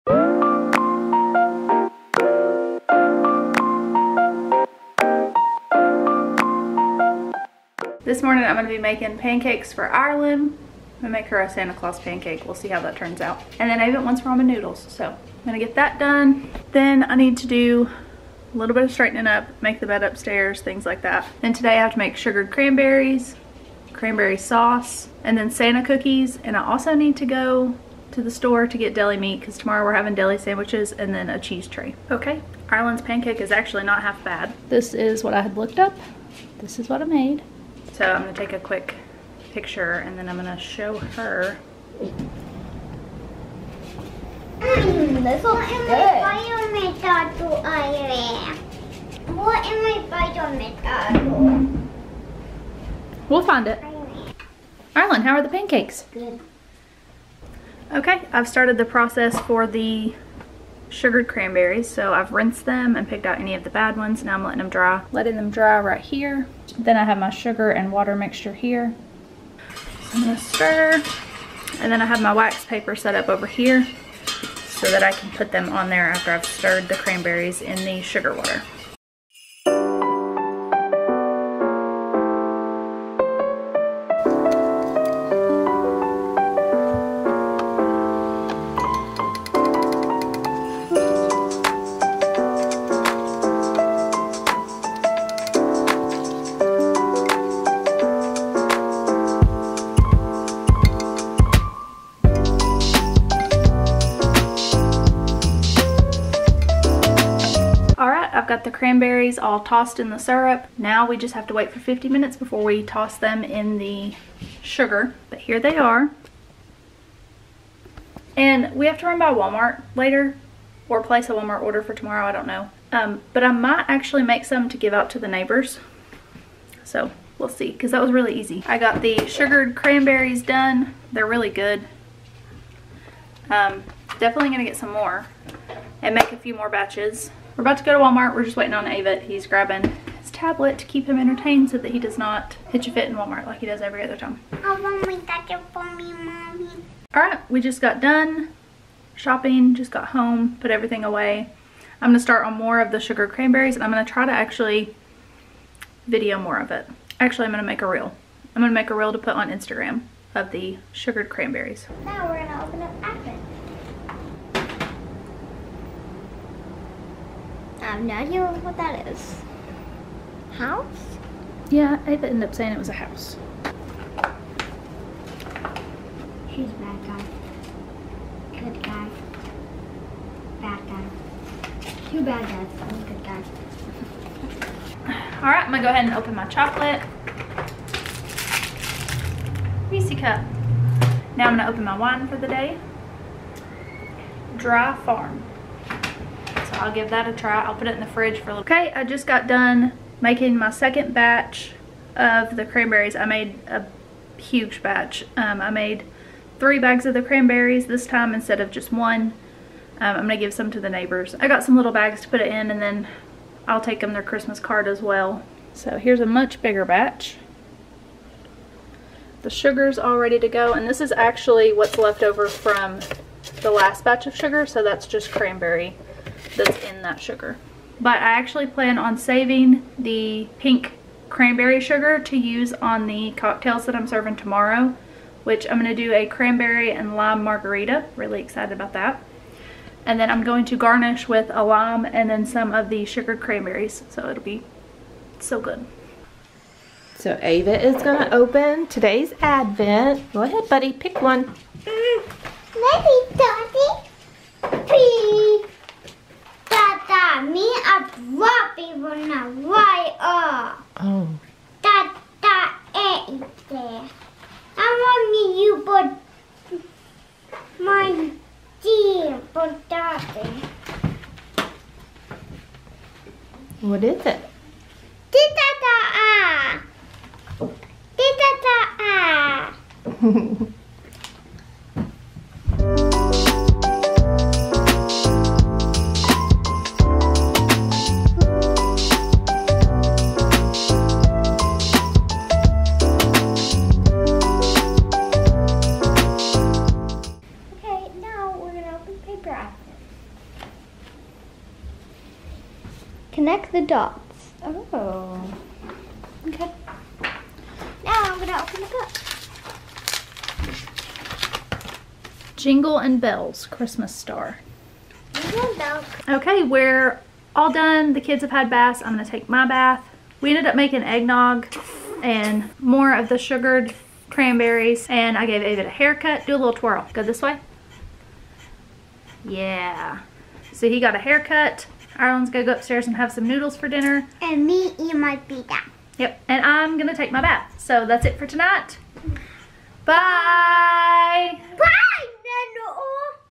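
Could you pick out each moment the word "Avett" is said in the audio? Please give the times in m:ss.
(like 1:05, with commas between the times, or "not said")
0:13, 2:18, 2:52, 4:07, 5:25.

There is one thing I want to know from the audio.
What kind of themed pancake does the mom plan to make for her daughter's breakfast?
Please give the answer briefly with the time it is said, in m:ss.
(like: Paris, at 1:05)
Santa Claus, at 0:11.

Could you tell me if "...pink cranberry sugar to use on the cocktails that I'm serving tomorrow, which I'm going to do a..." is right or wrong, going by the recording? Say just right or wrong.
right.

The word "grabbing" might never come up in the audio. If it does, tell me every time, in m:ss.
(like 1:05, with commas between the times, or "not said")
2:19.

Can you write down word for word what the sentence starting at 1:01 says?
So I've rinsed them and picked out any of the bad ones.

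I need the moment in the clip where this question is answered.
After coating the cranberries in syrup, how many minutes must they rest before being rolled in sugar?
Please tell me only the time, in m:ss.
1:51.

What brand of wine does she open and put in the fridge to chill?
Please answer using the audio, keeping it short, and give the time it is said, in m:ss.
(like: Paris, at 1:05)
Dry Farm, at 3:14.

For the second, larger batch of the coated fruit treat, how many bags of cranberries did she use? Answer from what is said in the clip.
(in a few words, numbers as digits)
3.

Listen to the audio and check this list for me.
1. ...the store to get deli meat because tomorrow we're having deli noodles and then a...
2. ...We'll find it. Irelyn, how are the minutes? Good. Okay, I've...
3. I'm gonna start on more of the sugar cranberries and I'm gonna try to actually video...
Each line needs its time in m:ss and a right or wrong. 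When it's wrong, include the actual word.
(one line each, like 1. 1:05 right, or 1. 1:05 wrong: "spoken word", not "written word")
1. 0:28 wrong: "sandwiches", not "noodles"
2. 0:53 wrong: "pancakes", not "minutes"
3. 2:32 right.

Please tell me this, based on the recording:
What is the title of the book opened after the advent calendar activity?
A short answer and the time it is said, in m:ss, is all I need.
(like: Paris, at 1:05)
Jingle and Bells Christmas Star, at 5:12.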